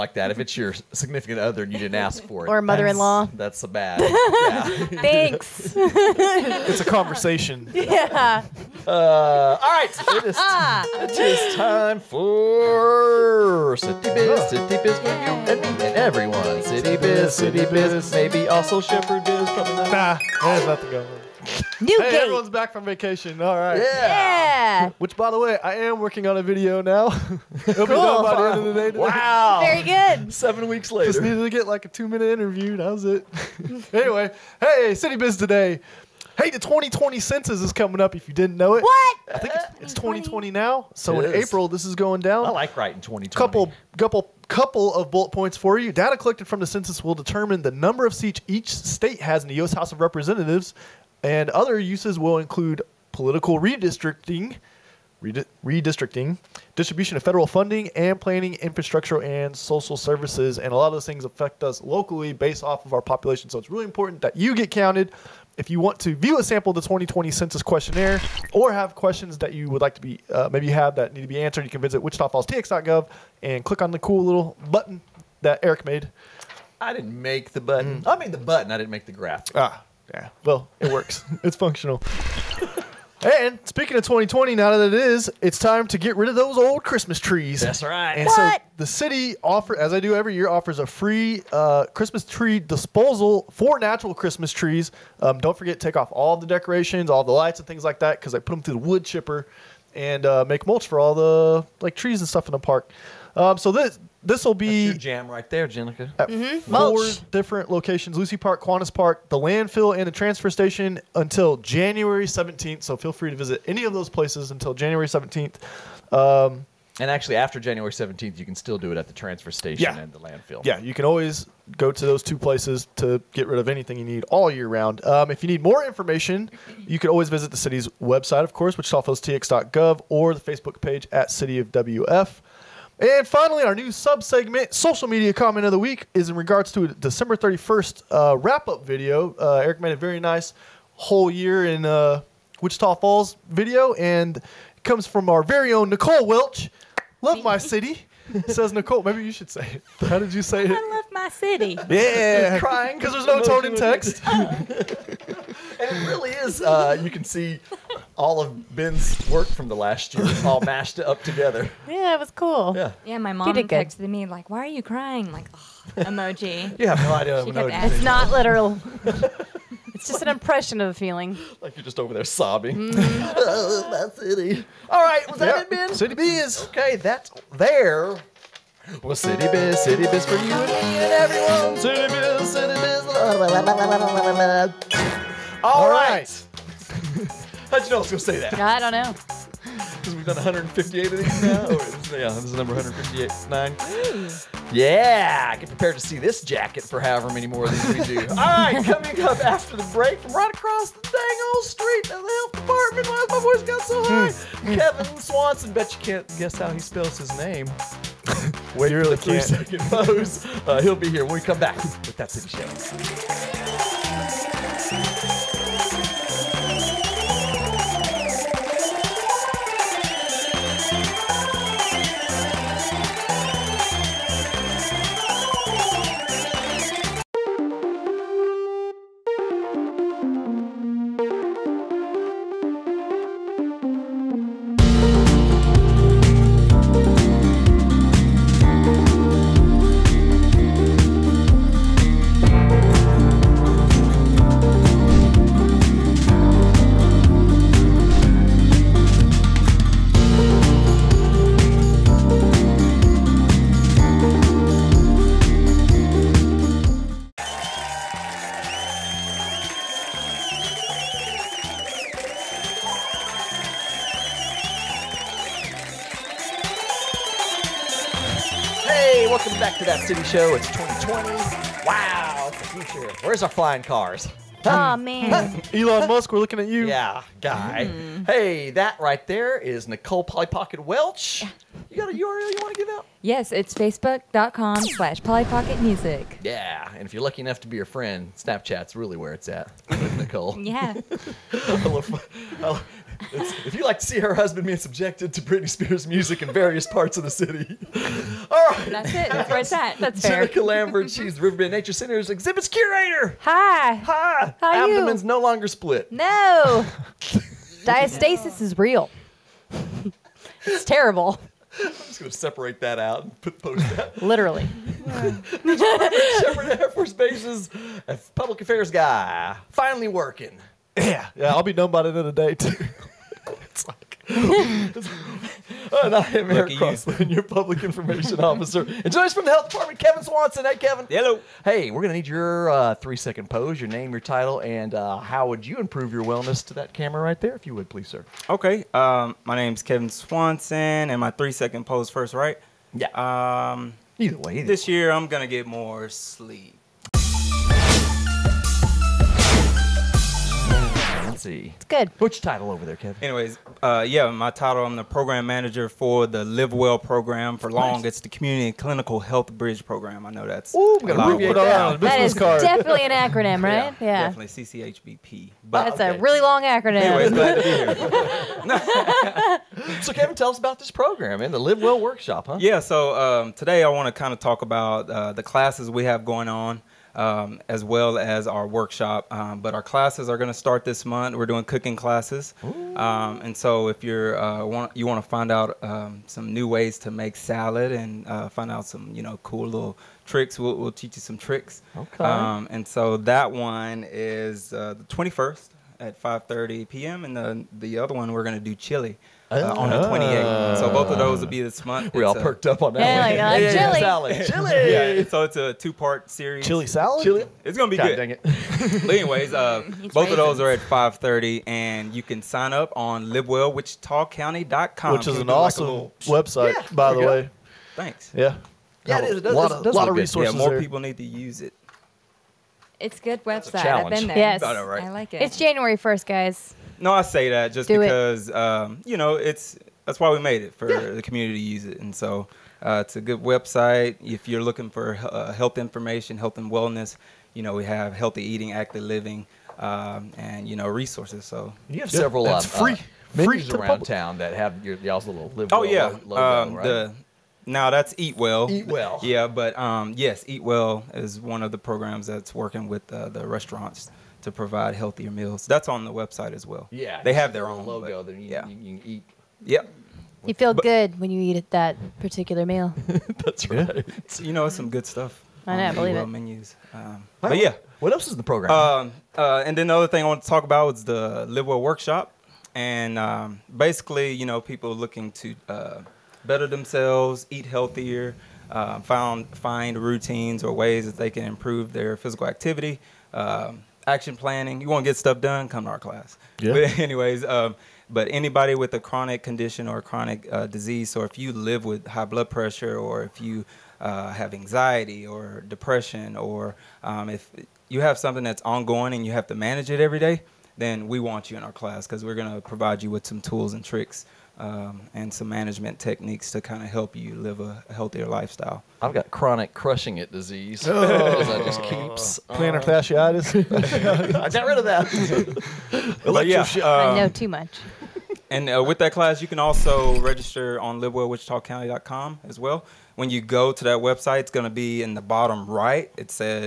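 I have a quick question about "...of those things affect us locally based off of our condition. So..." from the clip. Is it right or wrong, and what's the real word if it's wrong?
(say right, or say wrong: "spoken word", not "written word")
wrong: "population", not "condition".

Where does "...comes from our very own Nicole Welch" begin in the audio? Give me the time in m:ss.
2:24.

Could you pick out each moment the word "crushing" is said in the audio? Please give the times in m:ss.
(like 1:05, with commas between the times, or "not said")
8:29.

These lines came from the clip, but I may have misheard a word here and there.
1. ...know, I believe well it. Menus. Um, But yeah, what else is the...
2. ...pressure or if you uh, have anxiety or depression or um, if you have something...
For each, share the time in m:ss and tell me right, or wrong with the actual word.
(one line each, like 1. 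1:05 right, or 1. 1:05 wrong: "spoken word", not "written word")
1. 7:45 right
2. 8:12 right.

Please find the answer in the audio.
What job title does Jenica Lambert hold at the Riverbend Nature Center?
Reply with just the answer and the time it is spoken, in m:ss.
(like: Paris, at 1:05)
Exhibits curator, at 5:02.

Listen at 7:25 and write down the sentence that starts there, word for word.
oh well yeah, logo, um, right?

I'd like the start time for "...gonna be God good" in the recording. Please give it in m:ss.
6:47.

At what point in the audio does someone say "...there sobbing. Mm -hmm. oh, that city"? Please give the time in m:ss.
2:52.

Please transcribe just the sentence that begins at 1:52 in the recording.
So feel free to visit any of those places until January 17th.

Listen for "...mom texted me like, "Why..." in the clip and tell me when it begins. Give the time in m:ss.
2:43.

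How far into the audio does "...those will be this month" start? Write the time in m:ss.
6:41.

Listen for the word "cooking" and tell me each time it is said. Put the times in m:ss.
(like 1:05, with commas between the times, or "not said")
6:21.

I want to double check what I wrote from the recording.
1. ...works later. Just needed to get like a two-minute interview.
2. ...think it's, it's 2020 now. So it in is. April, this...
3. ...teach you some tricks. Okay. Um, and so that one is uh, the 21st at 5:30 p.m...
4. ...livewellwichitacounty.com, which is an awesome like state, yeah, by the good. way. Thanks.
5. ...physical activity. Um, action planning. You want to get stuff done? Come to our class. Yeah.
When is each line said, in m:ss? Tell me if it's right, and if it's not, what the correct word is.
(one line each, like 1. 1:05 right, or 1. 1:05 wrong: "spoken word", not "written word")
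1. 0:30 wrong: "weeks", not "works"
2. 0:39 right
3. 6:30 right
4. 6:53 wrong: "website", not "state"
5. 8:02 right.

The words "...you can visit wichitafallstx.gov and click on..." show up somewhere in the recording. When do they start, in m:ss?
1:11.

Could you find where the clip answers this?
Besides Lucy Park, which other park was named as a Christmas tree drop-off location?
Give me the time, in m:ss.
1:48.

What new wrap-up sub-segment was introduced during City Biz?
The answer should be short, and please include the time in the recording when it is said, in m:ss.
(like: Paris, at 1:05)
Social media comment of the week, at 2:14.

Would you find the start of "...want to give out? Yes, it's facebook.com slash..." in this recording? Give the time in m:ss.
4:42.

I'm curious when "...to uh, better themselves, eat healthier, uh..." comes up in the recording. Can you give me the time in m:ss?
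7:55.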